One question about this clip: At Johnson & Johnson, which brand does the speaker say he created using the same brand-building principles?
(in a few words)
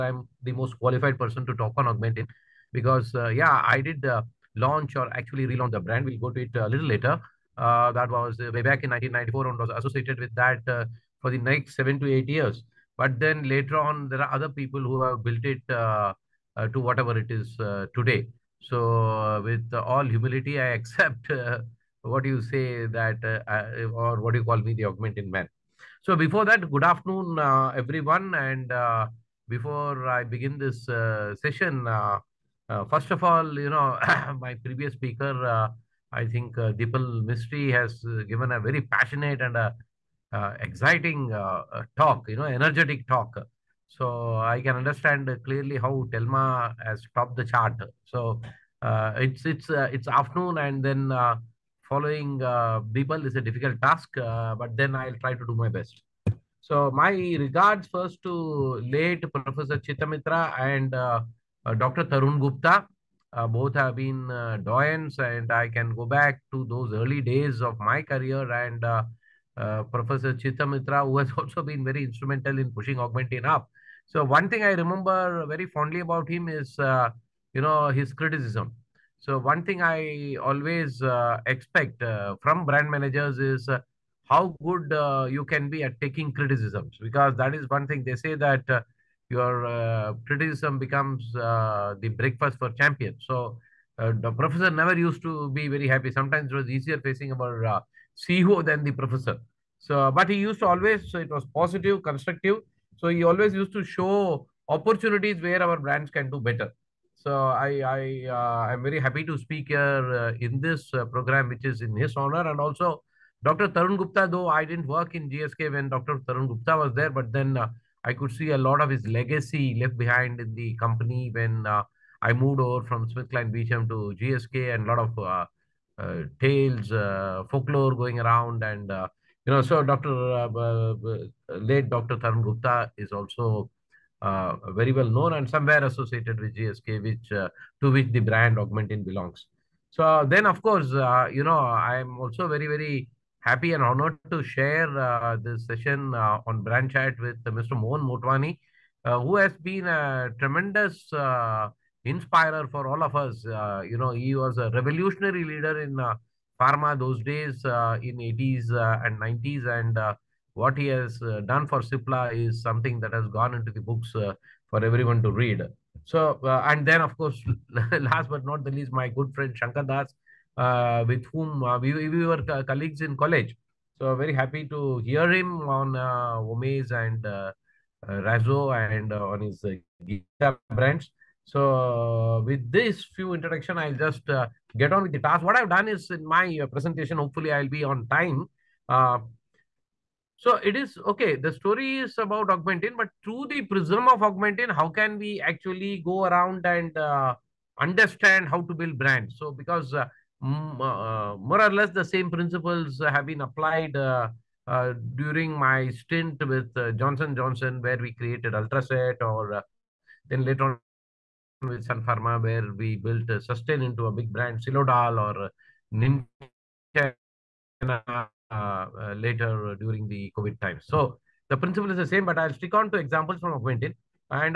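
Ultracet.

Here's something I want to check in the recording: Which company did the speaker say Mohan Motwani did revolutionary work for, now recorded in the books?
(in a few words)
Cipla.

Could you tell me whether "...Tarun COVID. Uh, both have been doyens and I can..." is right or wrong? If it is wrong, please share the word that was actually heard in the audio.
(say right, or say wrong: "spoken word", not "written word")
wrong: "Gupta", not "COVID".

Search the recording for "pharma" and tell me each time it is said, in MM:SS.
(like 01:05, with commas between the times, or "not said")
02:36, 03:32.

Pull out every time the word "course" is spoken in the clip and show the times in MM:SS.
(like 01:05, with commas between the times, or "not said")
02:20, 02:47.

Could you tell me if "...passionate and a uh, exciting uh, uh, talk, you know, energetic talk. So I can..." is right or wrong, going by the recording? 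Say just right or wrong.
right.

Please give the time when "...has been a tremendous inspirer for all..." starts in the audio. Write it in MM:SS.
02:29.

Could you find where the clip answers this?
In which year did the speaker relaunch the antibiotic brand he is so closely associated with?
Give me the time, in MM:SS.
00:08.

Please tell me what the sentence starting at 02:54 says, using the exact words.
So very happy to hear him on uh, and uh, Razo and on his uh, guitar brands.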